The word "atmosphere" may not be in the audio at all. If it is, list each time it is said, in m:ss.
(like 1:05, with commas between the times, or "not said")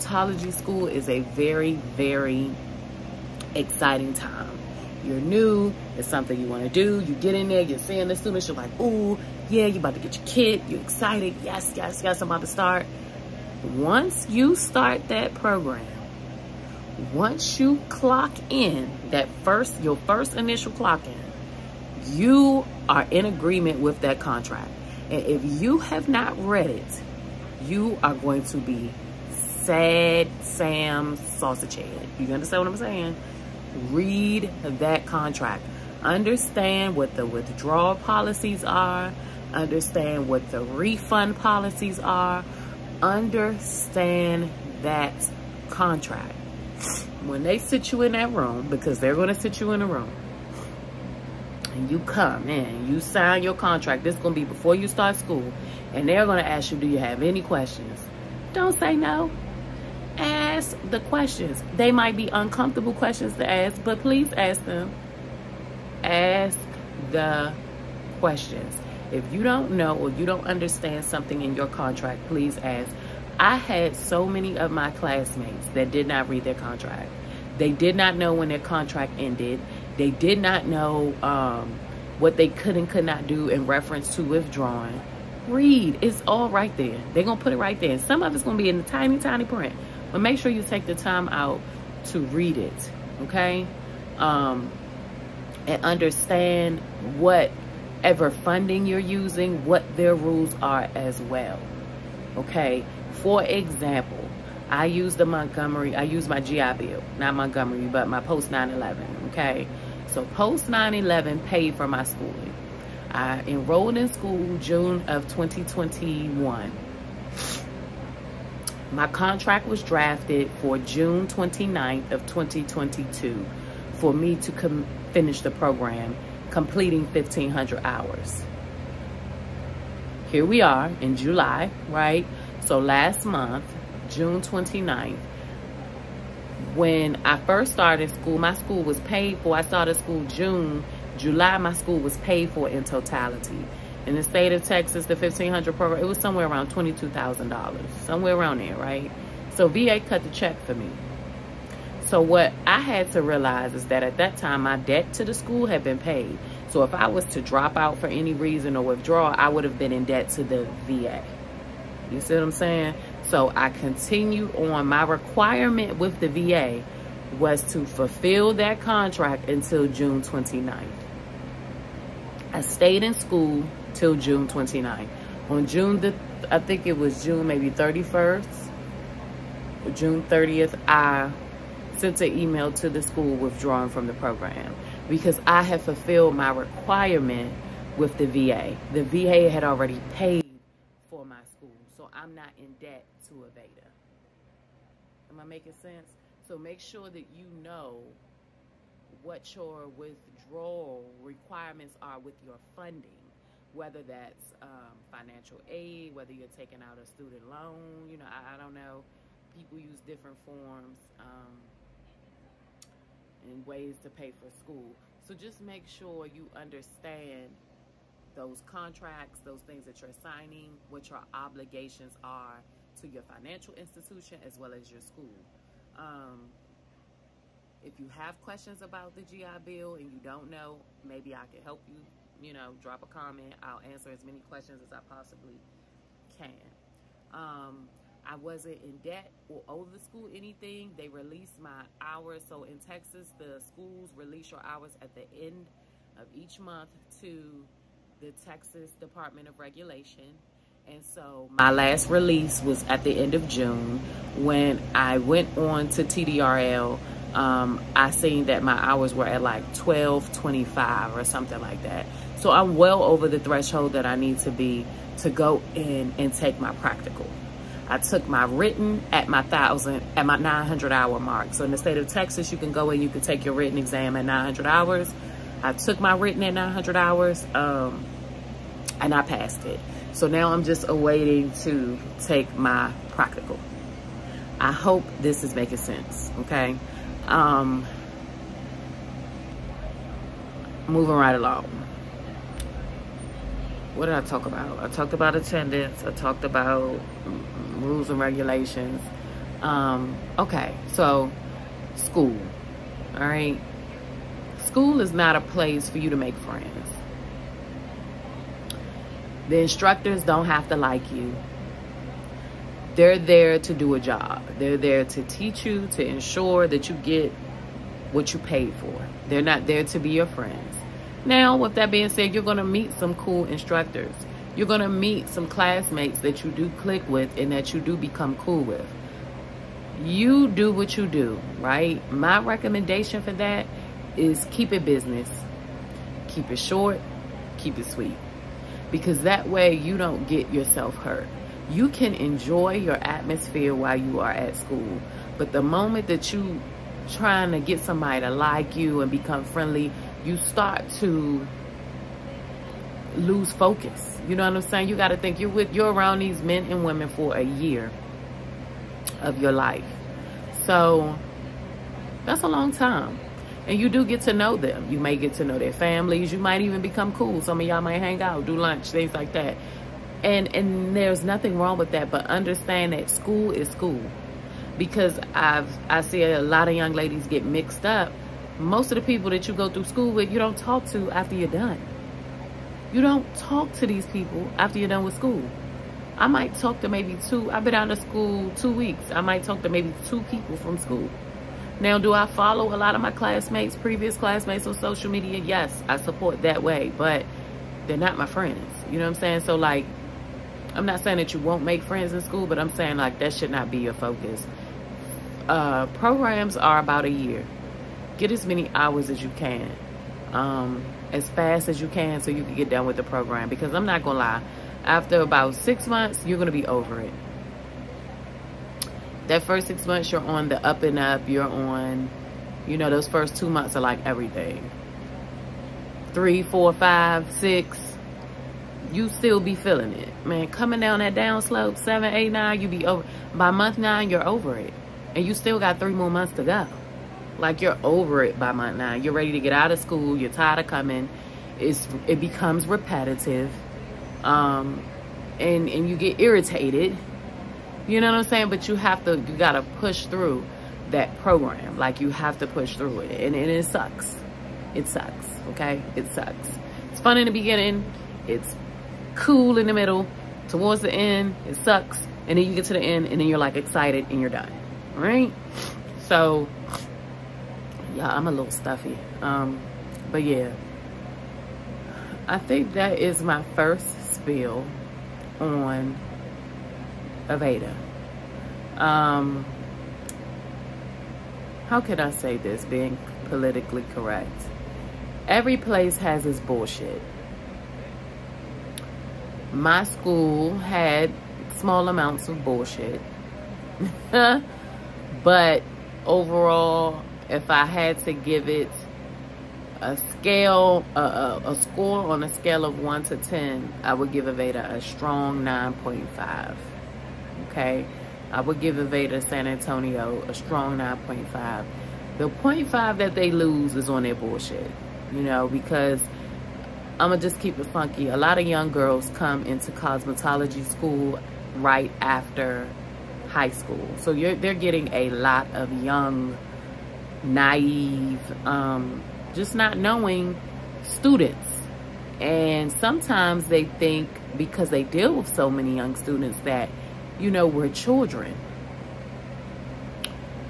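5:43.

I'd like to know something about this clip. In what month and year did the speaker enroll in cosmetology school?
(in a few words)
June 2021.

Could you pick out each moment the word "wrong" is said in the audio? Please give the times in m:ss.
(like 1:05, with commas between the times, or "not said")
6:11.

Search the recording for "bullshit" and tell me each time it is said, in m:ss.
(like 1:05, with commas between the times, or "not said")
8:06, 8:12, 8:34.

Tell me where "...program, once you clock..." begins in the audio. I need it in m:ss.
0:15.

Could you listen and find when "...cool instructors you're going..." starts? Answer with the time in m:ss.
5:23.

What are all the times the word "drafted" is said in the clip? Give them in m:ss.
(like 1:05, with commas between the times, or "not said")
1:59.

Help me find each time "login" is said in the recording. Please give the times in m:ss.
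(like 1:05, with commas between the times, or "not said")
not said.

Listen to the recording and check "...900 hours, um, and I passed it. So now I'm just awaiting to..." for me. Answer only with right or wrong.
right.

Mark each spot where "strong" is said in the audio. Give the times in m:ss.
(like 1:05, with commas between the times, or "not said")
8:24, 8:30.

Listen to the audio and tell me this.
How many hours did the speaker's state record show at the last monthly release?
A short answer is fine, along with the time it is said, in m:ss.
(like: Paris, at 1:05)
1225, at 4:19.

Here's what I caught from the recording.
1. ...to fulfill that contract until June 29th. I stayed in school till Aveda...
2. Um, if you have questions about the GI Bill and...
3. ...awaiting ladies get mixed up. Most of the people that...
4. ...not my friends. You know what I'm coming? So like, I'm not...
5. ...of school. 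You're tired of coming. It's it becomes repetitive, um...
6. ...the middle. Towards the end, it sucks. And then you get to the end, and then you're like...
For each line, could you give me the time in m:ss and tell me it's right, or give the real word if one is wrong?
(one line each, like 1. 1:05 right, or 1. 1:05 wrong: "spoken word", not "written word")
1. 2:47 wrong: "June", not "Aveda"
2. 3:45 right
3. 6:16 wrong: "young", not "awaiting"
4. 6:37 wrong: "saying", not "coming"
5. 7:19 right
6. 7:39 right.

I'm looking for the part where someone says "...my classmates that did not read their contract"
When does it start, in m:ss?
1:14.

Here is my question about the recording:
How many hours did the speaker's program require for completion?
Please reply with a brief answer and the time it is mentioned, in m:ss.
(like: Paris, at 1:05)
1,500, at 2:07.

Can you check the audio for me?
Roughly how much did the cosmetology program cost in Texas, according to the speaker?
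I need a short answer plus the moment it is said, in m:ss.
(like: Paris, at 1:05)
$22,000, at 2:26.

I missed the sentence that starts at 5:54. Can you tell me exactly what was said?
You got to think you're with you're around these men and women for a year of your life.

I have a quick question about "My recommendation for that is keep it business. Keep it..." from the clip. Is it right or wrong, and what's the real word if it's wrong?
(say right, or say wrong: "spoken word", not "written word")
right.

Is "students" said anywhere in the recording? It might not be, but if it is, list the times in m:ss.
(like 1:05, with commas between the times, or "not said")
0:08, 3:27, 8:50, 8:55.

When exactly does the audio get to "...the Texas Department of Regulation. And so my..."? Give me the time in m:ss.
4:08.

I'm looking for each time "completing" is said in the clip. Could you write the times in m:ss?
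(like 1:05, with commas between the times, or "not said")
2:06.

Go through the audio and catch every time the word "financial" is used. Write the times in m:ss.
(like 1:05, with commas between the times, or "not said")
3:25, 3:43.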